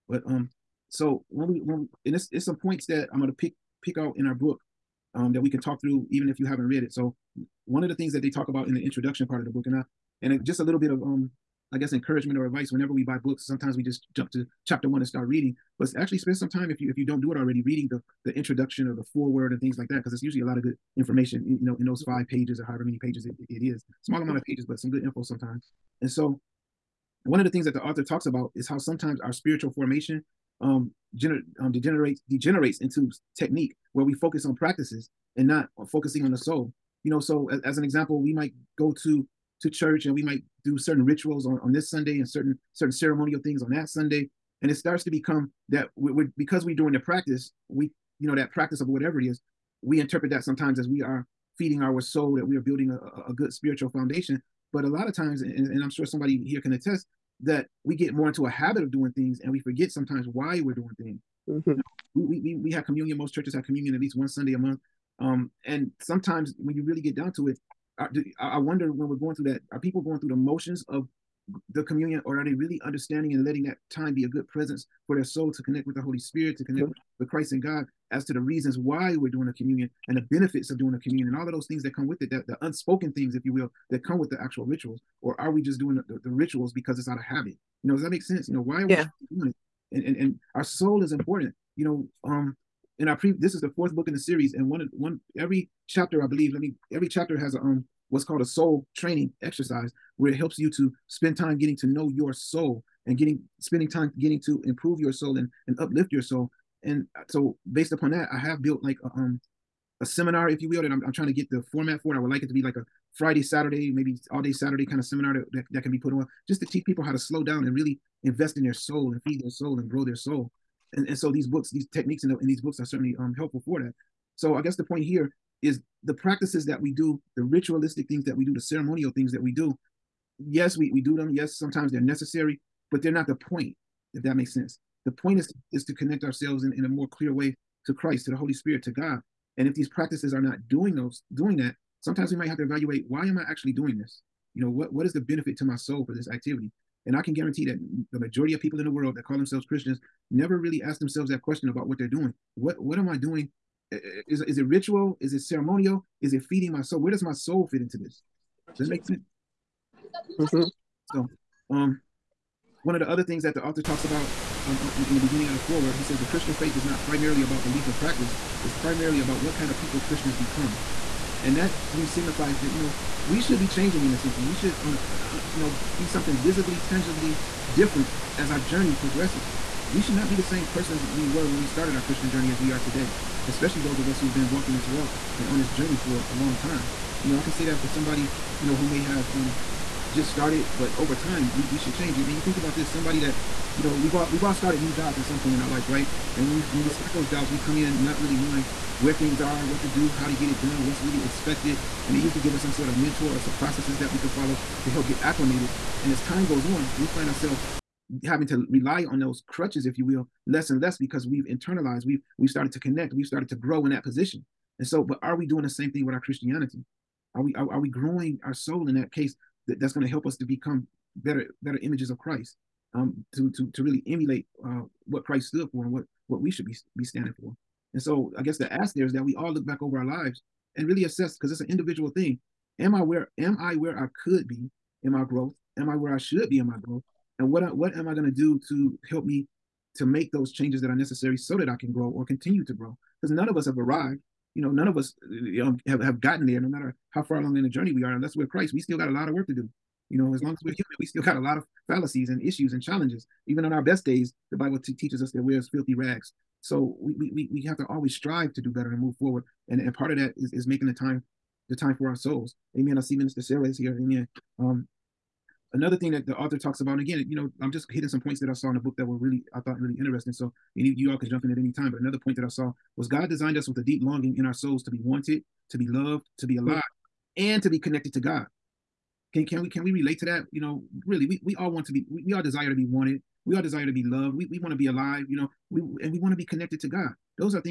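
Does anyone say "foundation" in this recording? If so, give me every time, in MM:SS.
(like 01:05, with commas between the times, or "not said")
00:53.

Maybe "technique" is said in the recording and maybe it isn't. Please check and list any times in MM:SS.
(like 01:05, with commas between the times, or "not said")
00:33, 02:01.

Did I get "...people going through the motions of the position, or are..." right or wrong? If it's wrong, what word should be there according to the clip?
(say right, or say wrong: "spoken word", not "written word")
wrong: "communion", not "position".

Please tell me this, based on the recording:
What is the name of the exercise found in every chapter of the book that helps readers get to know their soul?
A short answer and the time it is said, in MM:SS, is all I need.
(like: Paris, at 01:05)
soul training exercise, at 01:38.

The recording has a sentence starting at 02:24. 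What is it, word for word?
You know, what what is the benefit to my soul for this activity?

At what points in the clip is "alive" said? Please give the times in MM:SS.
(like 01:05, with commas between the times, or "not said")
04:36, 04:44.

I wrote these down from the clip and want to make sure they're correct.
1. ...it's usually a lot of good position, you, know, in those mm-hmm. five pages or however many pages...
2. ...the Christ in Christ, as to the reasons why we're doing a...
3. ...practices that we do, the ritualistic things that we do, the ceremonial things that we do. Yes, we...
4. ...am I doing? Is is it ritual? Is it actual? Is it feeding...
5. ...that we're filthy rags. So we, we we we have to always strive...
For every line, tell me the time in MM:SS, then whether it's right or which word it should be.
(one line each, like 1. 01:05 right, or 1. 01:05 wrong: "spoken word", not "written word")
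1. 00:20 wrong: "information", not "position"
2. 01:17 wrong: "God", not "Christ"
3. 02:06 right
4. 02:32 wrong: "ceremonial", not "actual"
5. 04:15 right.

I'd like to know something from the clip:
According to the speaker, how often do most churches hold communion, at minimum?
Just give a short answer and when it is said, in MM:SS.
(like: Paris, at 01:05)
At least one Sunday a month, at 01:03.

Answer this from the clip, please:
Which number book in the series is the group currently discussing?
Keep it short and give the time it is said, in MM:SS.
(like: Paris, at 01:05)
fourth, at 01:33.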